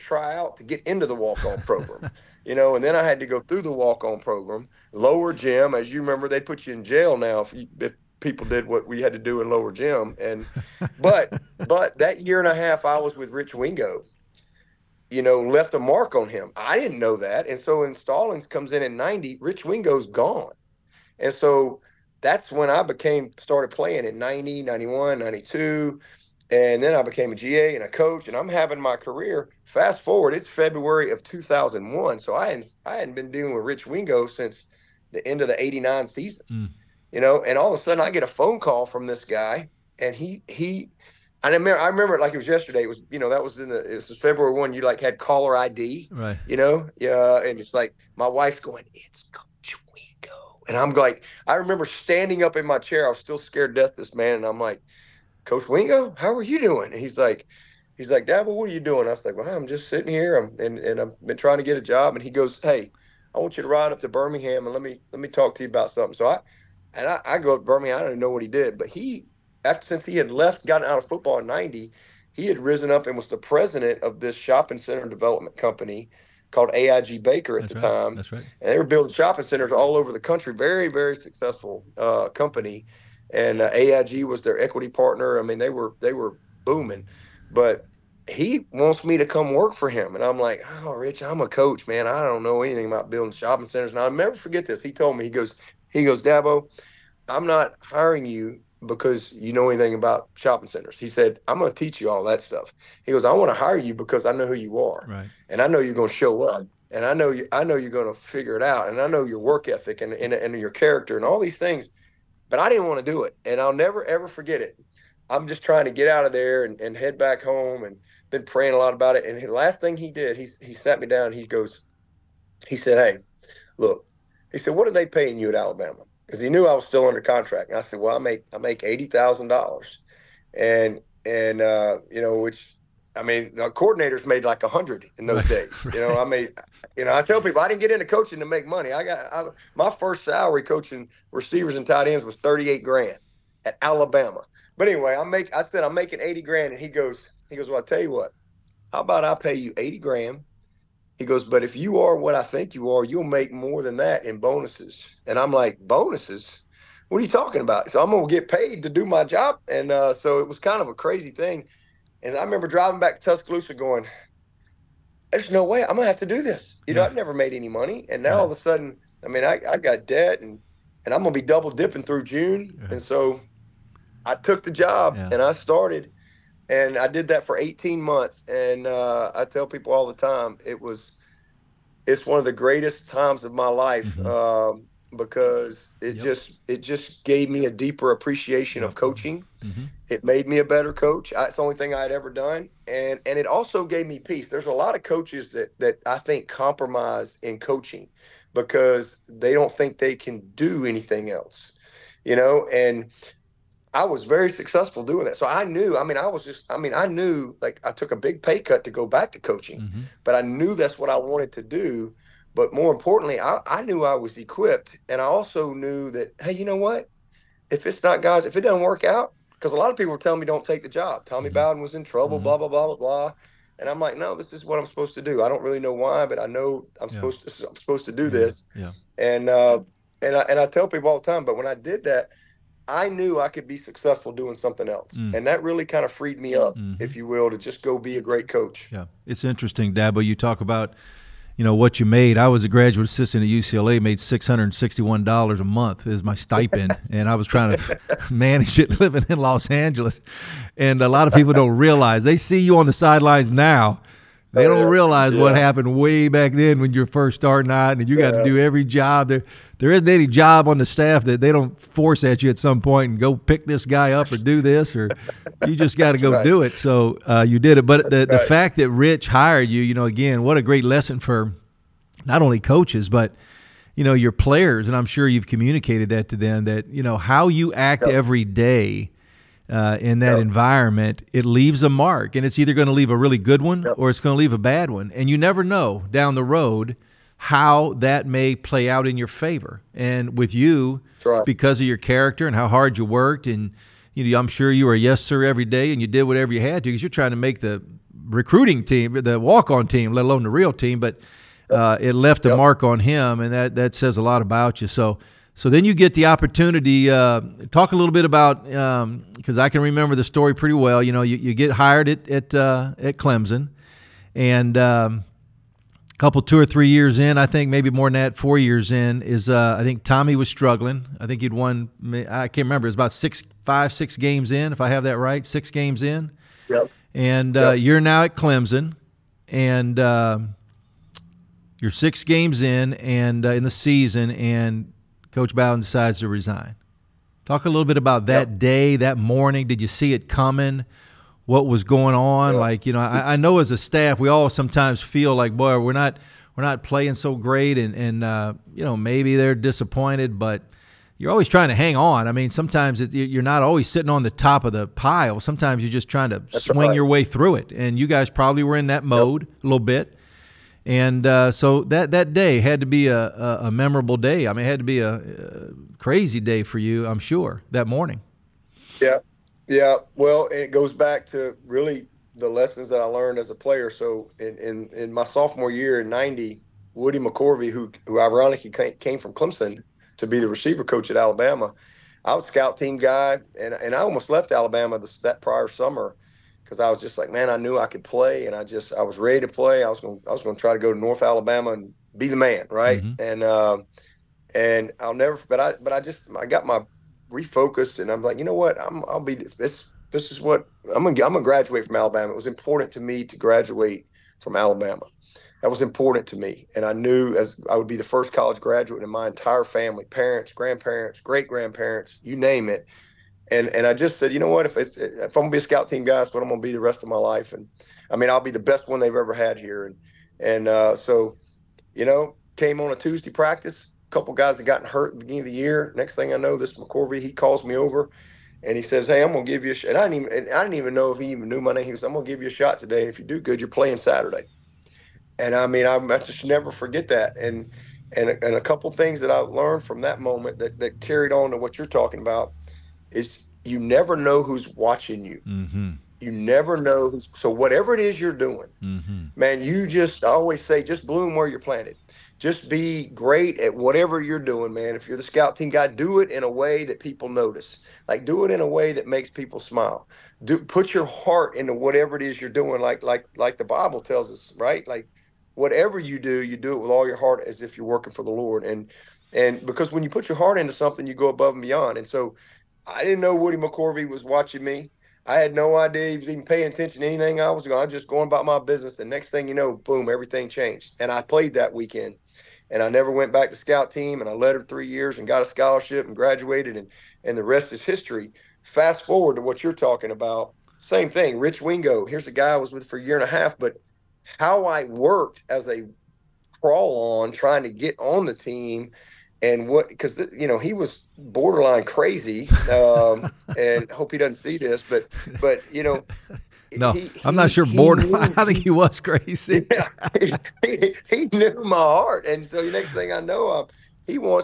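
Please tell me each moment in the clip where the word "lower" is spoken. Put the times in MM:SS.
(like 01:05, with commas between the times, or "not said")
00:04, 00:09.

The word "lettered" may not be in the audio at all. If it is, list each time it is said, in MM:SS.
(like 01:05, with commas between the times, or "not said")
08:04.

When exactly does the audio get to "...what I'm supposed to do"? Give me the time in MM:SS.
03:44.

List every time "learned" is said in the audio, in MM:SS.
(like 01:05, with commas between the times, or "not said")
06:13, 07:19.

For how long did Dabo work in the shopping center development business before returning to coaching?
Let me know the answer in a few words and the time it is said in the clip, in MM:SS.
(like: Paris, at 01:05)
18 months, at 02:57.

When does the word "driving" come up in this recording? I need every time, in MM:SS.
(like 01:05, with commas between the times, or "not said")
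02:42.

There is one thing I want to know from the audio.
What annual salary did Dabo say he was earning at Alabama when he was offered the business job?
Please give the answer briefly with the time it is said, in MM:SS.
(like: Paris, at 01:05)
$80,000, at 02:08.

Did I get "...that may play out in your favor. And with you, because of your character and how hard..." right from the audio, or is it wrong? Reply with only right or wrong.
right.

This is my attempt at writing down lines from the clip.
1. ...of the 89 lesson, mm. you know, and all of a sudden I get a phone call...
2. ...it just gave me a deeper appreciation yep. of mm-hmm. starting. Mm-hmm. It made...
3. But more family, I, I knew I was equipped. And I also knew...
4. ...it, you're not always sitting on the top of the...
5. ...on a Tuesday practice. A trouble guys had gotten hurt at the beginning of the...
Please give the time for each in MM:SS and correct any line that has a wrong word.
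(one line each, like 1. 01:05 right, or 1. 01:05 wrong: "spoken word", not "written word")
1. 00:35 wrong: "season", not "lesson"
2. 03:06 wrong: "coaching", not "starting"
3. 03:32 wrong: "importantly", not "family"
4. 05:53 right
5. 07:02 wrong: "couple", not "trouble".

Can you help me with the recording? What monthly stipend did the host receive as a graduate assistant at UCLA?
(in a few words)
$661.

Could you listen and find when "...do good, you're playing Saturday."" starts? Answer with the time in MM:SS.
07:13.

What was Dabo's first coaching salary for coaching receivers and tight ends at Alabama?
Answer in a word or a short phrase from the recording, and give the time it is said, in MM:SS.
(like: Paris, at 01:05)
thirty eight grand, at 02:22.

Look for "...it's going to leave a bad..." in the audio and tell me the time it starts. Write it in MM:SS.
04:44.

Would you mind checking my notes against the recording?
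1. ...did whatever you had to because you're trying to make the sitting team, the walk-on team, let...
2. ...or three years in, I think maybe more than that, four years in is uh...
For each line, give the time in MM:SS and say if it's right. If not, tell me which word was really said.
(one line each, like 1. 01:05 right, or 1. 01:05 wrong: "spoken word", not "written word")
1. 04:56 wrong: "recruiting", not "sitting"
2. 05:16 right.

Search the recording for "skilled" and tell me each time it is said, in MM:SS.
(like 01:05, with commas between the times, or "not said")
not said.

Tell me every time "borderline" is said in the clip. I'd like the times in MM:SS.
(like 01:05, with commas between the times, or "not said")
08:21, 08:27.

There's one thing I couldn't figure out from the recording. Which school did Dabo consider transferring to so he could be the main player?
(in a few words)
North Alabama.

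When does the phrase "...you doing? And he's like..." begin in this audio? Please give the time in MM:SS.
00:56.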